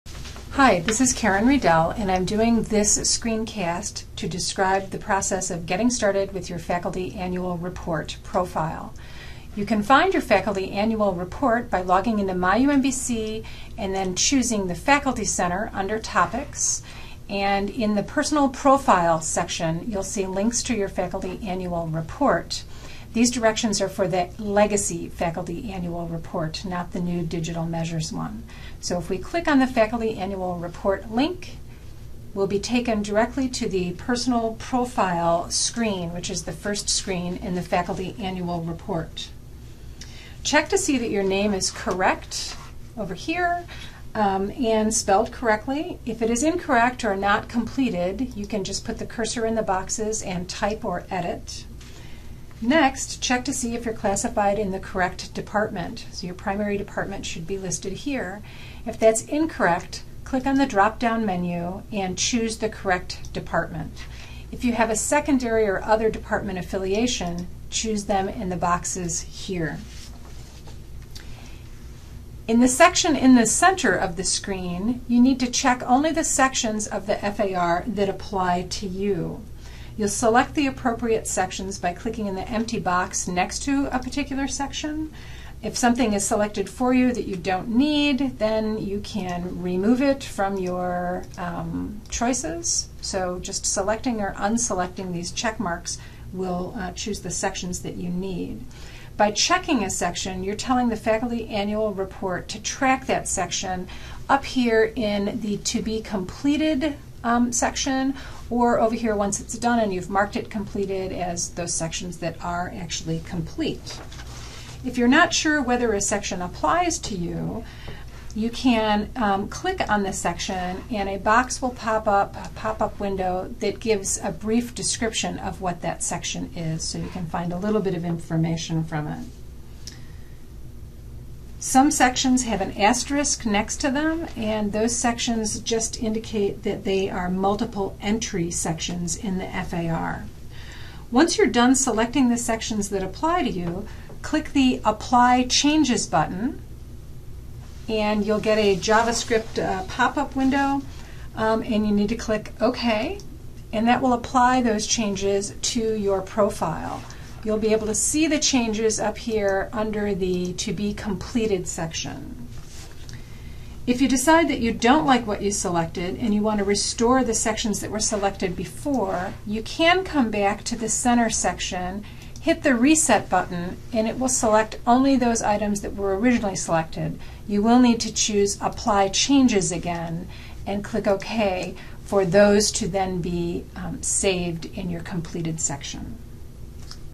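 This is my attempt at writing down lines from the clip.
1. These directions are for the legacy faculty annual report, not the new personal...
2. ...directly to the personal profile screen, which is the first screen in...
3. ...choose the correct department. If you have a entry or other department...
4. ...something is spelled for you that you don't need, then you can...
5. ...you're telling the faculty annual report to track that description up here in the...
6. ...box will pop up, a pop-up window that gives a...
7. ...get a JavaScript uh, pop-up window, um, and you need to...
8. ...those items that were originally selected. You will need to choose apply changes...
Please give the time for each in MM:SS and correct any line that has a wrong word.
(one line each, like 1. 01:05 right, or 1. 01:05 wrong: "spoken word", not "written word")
1. 00:23 wrong: "digital", not "personal"
2. 00:33 right
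3. 01:02 wrong: "secondary", not "entry"
4. 01:25 wrong: "selected", not "spelled"
5. 01:40 wrong: "section", not "description"
6. 02:01 right
7. 02:28 right
8. 02:55 right.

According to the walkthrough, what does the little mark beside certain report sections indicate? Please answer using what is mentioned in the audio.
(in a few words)
multiple entry sections.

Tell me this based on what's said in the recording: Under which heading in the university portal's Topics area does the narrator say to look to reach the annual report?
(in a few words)
Faculty Center.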